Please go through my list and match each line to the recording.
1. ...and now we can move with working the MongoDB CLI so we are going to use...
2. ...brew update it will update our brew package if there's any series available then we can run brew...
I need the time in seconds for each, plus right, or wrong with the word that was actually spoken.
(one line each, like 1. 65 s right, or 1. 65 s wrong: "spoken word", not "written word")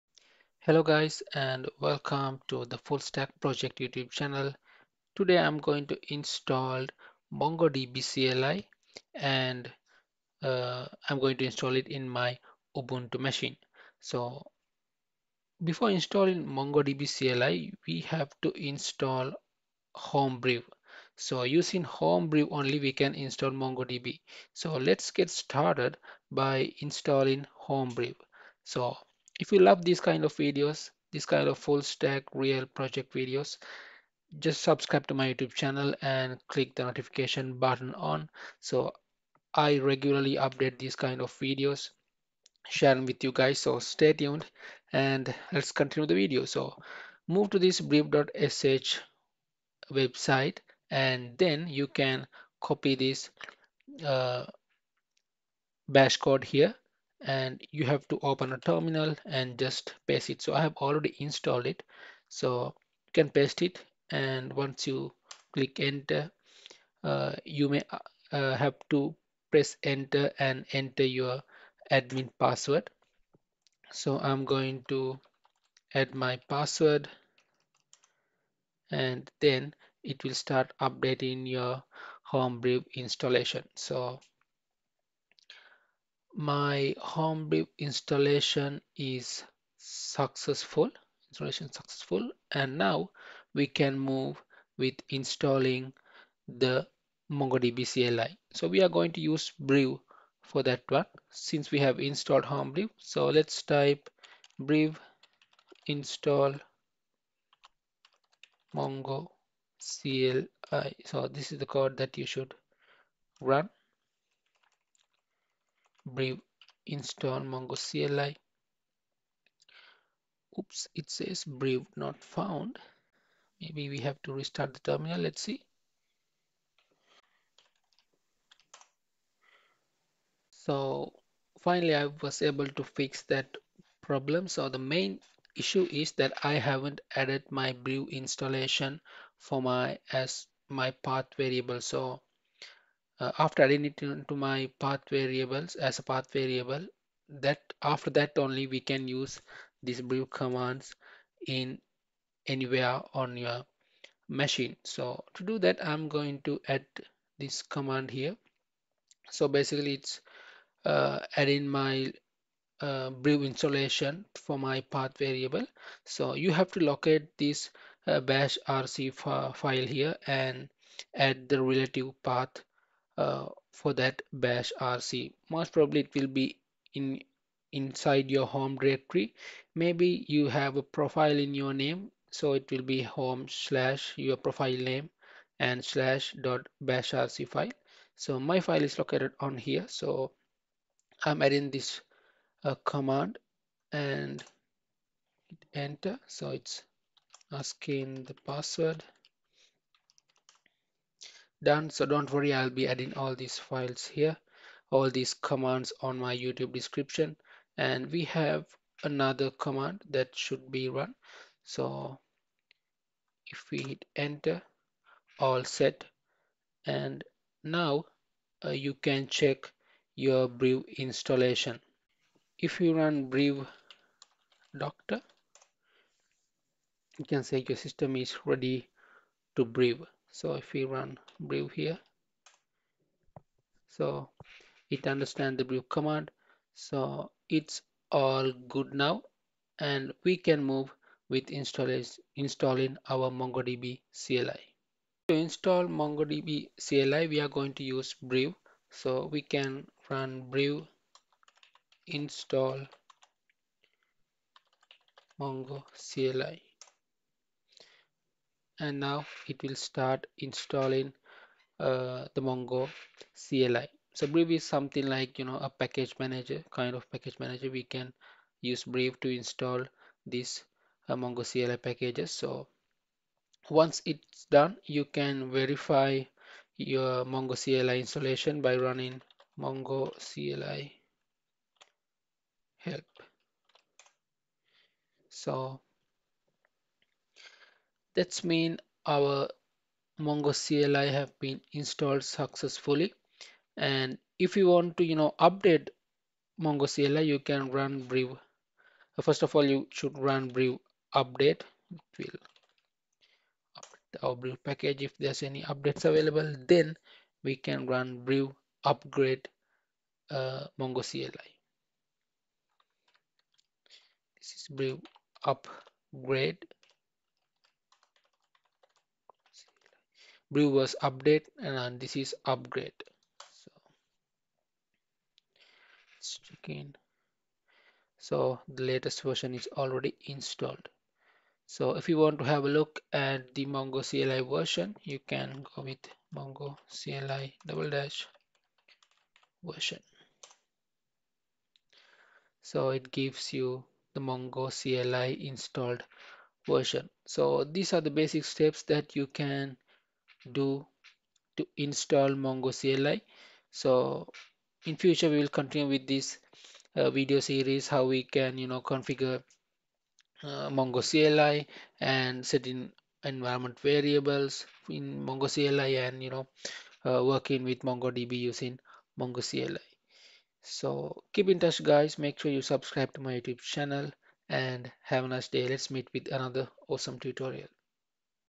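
1. 92 s wrong: "installing", not "working"
2. 300 s wrong: "updates", not "series".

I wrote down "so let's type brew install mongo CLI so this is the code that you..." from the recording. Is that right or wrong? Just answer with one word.
right.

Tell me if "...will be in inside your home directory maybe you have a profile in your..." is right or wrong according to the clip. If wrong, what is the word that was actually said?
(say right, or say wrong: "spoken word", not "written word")
right.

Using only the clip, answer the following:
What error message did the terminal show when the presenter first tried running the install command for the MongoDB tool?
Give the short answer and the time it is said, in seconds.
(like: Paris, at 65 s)
brew not found, at 121 s.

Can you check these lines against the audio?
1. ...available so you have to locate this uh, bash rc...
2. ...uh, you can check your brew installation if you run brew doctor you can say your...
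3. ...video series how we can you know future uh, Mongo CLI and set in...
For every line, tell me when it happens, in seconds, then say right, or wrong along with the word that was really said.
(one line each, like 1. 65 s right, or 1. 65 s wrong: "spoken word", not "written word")
1. 165 s wrong: "variable", not "available"
2. 218 s right
3. 357 s wrong: "configure", not "future".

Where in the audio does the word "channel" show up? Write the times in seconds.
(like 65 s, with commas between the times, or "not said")
4 s, 35 s, 373 s.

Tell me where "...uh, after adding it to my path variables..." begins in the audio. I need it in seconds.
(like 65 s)
143 s.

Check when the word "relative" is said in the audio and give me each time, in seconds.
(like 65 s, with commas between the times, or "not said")
171 s.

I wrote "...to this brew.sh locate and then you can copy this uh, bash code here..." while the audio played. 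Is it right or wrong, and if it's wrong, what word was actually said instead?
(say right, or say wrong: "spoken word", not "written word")
wrong: "website", not "locate".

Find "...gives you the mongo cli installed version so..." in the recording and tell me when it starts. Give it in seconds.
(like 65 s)
343 s.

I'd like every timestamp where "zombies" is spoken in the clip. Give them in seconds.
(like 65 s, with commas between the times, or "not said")
not said.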